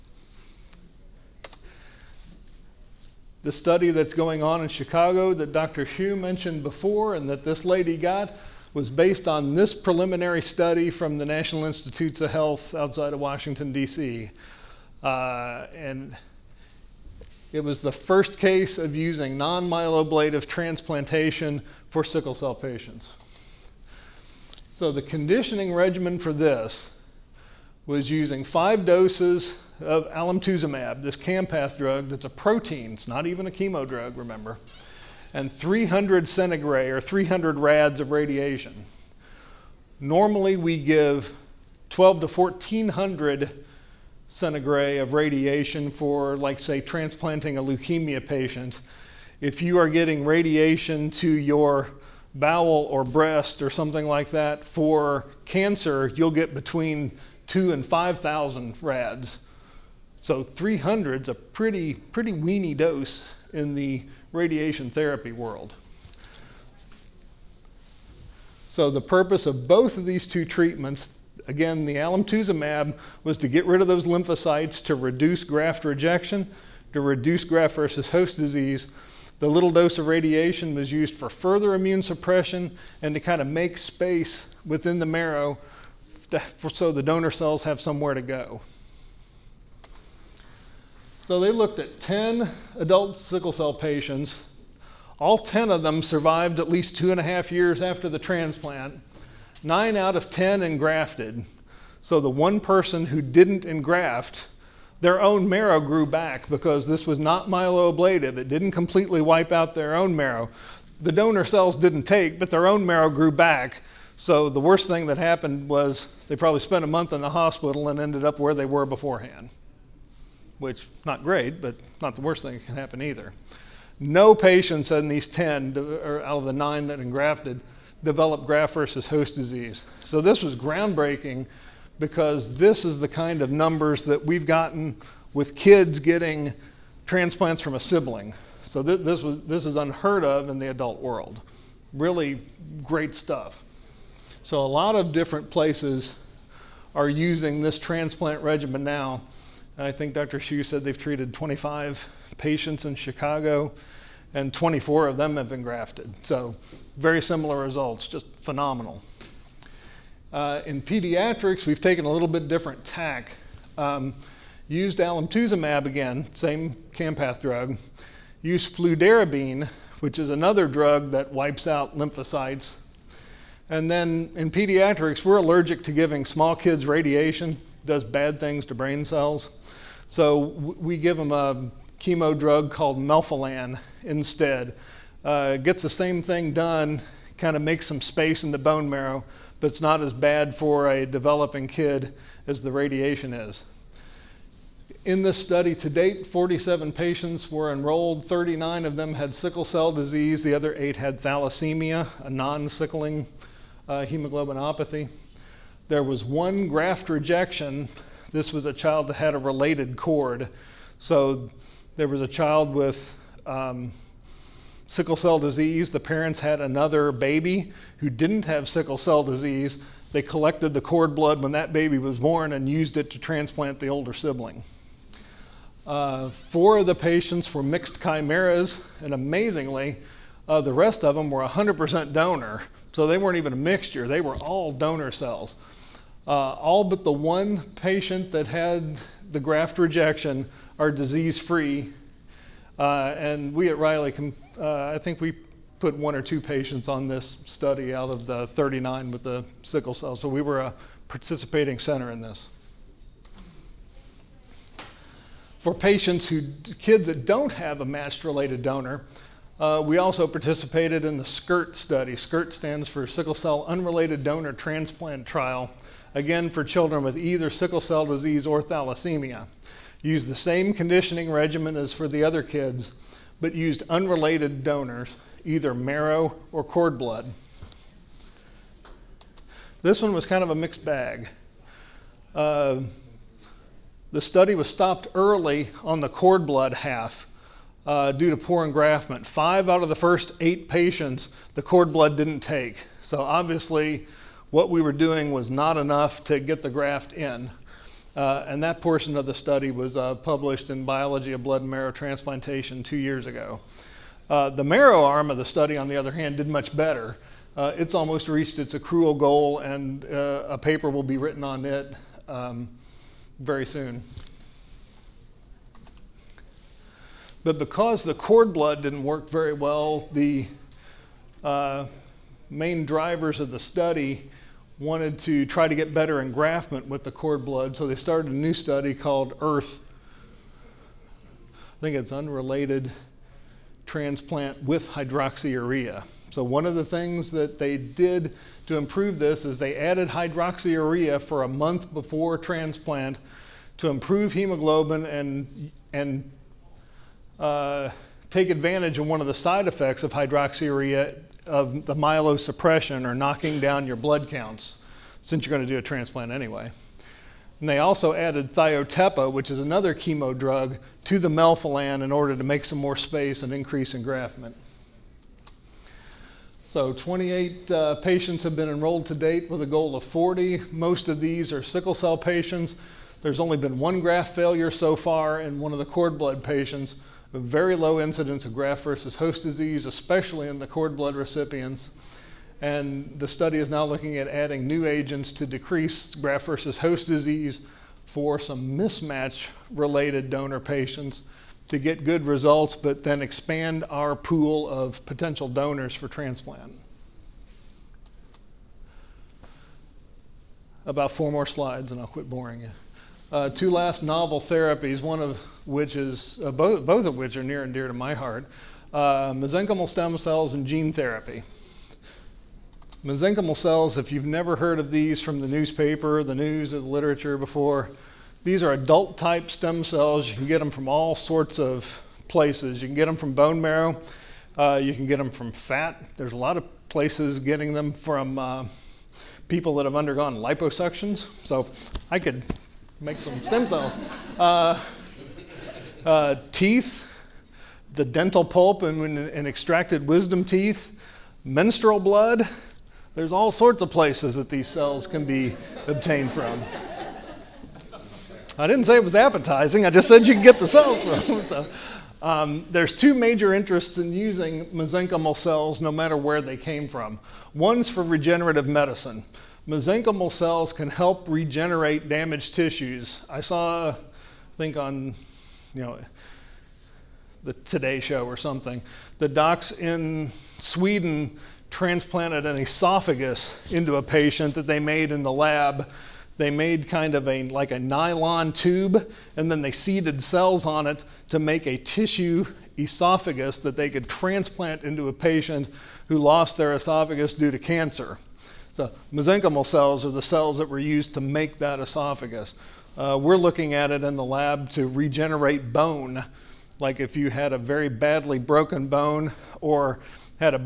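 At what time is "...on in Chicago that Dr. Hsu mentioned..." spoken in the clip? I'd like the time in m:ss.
0:04.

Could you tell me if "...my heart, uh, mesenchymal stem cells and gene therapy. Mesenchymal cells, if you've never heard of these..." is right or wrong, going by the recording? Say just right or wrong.
right.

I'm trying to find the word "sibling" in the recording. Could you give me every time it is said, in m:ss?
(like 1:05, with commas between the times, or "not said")
2:17, 3:44.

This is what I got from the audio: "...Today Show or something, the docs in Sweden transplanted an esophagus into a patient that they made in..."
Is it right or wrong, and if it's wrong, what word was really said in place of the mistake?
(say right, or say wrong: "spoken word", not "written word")
right.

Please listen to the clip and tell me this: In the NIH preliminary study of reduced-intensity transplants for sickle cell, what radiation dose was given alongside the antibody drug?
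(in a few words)
300 centigray.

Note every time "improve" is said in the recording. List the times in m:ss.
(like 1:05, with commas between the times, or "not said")
5:38, 5:43.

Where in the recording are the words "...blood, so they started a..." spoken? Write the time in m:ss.
5:27.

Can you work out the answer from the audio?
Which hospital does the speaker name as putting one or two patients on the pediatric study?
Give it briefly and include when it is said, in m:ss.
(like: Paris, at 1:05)
Riley, at 4:03.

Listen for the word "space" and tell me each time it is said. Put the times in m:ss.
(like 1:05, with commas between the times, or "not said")
1:23, 3:08, 6:02.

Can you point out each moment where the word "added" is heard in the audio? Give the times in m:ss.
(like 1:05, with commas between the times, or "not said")
5:39, 5:58.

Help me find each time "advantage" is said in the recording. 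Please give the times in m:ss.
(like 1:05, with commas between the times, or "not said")
5:48.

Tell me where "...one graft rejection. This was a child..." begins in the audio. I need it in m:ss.
3:26.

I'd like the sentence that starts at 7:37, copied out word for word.
One's for regenerative medicine mesenchymal cells can help regenerate damaged tissues.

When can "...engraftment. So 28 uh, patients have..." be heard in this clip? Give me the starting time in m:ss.
6:03.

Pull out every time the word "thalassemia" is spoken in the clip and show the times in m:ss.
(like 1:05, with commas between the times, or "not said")
3:21, 4:28.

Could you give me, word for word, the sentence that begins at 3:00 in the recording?
So we give them a chemo drug called melphalan instead.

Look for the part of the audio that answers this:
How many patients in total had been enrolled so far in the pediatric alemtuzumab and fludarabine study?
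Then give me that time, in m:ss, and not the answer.
3:16.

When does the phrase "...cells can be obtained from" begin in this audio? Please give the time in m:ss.
7:24.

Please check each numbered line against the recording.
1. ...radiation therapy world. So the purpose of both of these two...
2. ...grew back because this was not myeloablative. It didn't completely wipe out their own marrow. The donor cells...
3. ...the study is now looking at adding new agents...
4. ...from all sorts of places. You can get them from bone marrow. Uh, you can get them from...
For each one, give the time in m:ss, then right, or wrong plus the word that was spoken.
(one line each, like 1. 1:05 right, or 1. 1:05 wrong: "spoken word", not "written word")
1. 1:04 right
2. 1:45 right
3. 6:23 right
4. 7:00 right.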